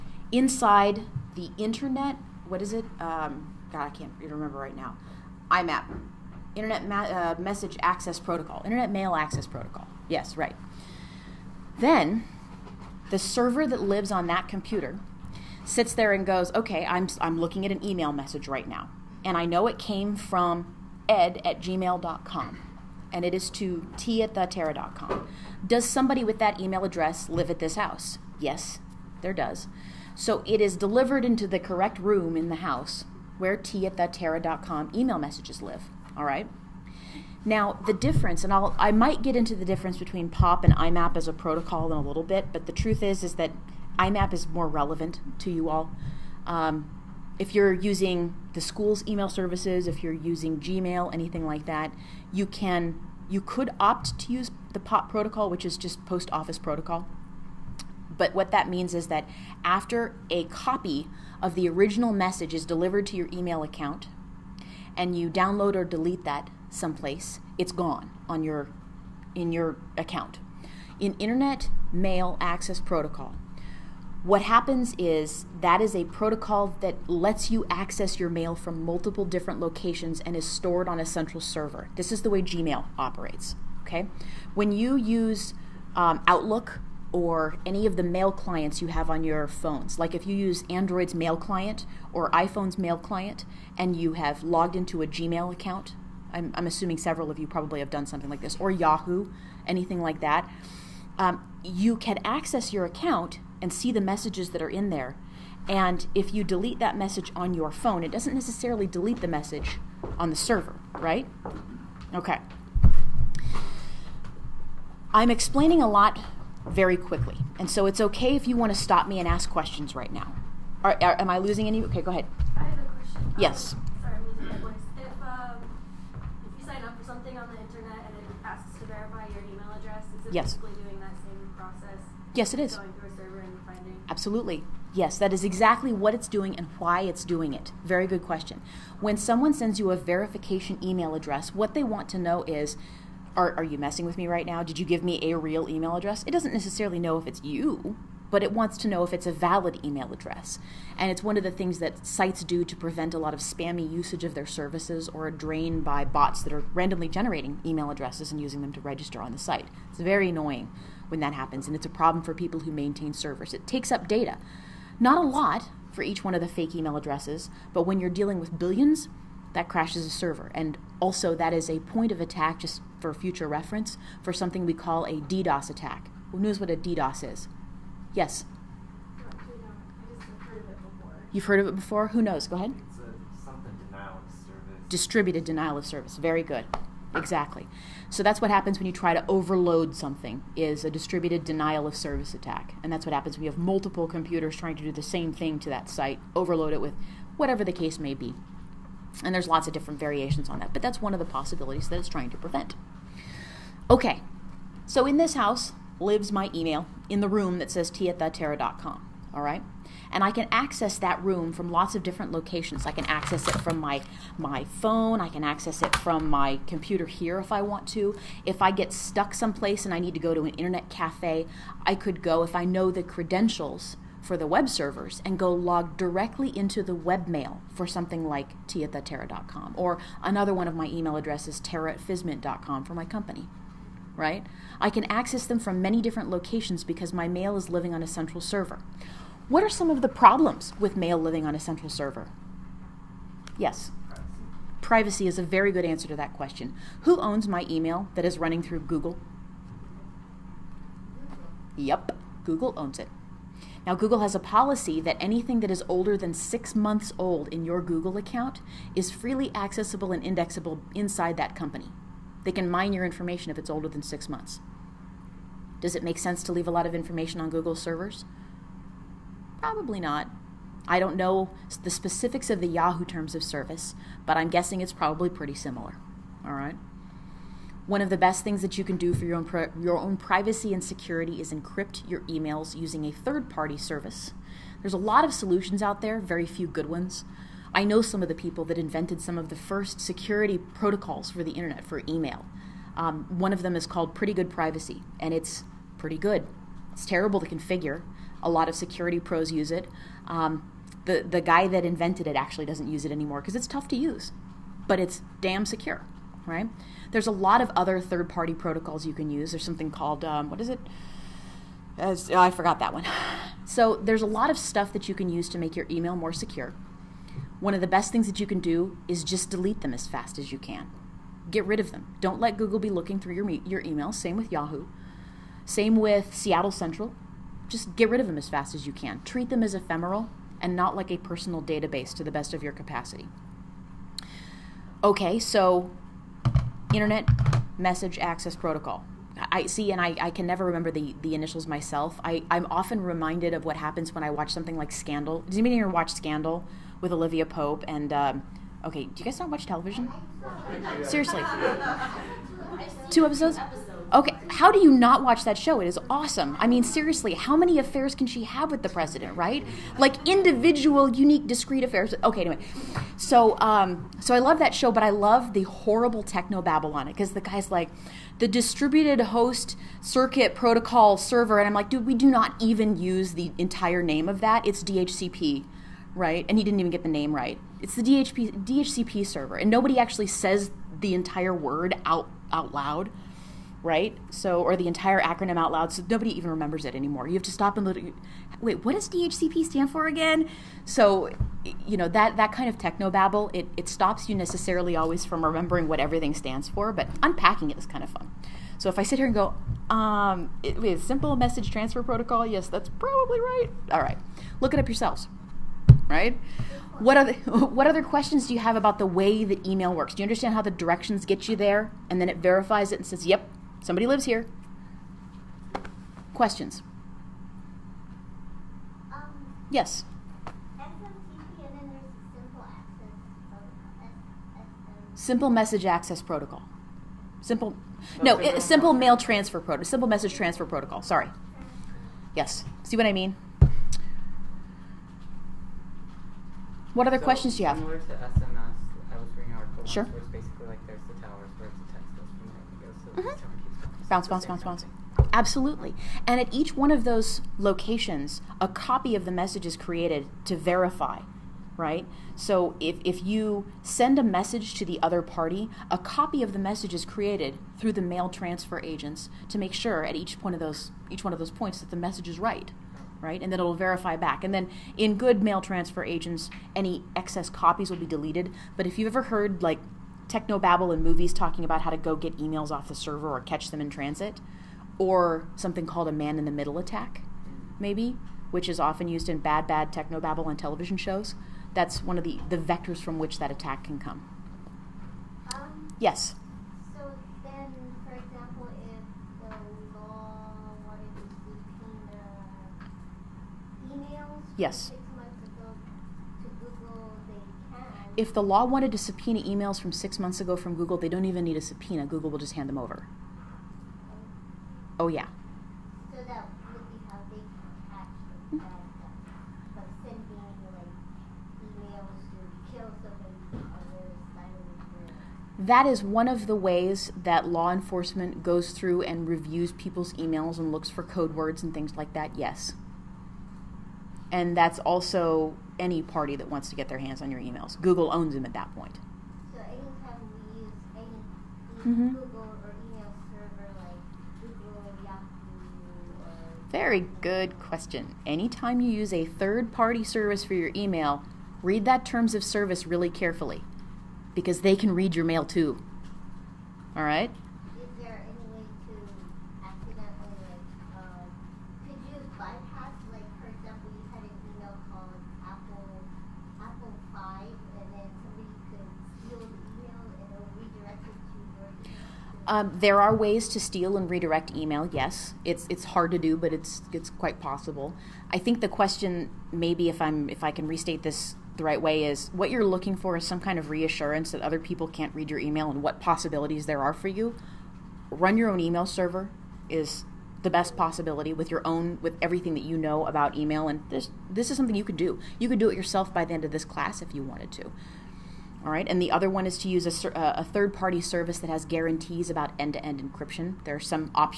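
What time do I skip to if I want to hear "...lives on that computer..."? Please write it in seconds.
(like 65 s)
13 s.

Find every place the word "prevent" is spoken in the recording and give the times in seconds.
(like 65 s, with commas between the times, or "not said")
152 s, 202 s.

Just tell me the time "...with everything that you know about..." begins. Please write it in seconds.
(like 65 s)
581 s.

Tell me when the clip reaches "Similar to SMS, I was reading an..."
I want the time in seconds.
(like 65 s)
437 s.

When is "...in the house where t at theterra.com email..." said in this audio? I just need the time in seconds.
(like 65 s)
32 s.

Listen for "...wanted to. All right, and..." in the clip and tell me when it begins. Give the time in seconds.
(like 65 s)
587 s.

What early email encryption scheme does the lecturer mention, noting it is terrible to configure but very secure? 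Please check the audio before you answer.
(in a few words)
Pretty Good Privacy.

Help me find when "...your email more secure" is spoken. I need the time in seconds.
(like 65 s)
315 s.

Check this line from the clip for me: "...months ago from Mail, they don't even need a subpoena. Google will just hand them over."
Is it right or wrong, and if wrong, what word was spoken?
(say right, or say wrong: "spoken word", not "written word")
wrong: "Google", not "Mail".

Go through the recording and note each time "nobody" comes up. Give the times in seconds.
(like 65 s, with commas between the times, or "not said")
379 s, 386 s.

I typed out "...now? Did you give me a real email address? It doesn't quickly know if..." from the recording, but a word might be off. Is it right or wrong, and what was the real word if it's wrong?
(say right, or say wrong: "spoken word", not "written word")
wrong: "necessarily", not "quickly".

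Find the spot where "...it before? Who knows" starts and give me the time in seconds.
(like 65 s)
181 s.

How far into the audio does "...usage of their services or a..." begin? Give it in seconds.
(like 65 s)
153 s.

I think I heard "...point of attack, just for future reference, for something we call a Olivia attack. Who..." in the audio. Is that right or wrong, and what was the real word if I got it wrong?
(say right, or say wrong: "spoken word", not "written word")
wrong: "DDoS", not "Olivia".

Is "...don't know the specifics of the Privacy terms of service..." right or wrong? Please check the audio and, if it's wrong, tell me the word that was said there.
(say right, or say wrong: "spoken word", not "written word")
wrong: "Yahoo", not "Privacy".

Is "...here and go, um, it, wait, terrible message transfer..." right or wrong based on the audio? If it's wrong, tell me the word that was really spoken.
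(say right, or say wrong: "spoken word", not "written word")
wrong: "simple", not "terrible".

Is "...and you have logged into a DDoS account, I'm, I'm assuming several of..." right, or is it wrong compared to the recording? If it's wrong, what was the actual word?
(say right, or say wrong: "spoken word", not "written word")
wrong: "Gmail", not "DDoS".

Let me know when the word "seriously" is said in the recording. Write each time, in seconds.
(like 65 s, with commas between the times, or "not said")
351 s, 356 s.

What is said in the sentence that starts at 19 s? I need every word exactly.
And I know it came from ed at gmail.com and it is to t at theterra.com.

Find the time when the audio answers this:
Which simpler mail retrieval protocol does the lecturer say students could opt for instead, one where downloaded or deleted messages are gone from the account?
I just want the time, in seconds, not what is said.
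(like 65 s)
56 s.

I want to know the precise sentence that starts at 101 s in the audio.
Um, you can access your account and see the messages that are in there.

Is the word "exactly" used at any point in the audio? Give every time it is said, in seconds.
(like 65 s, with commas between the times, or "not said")
135 s, 187 s.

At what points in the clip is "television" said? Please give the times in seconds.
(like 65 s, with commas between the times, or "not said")
349 s, 480 s.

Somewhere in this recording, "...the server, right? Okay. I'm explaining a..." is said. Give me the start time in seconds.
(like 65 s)
110 s.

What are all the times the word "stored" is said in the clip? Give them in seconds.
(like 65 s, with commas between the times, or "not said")
80 s.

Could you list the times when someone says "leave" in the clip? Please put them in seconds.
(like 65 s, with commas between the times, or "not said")
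266 s.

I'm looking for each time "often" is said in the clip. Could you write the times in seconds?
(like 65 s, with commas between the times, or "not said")
342 s, 478 s.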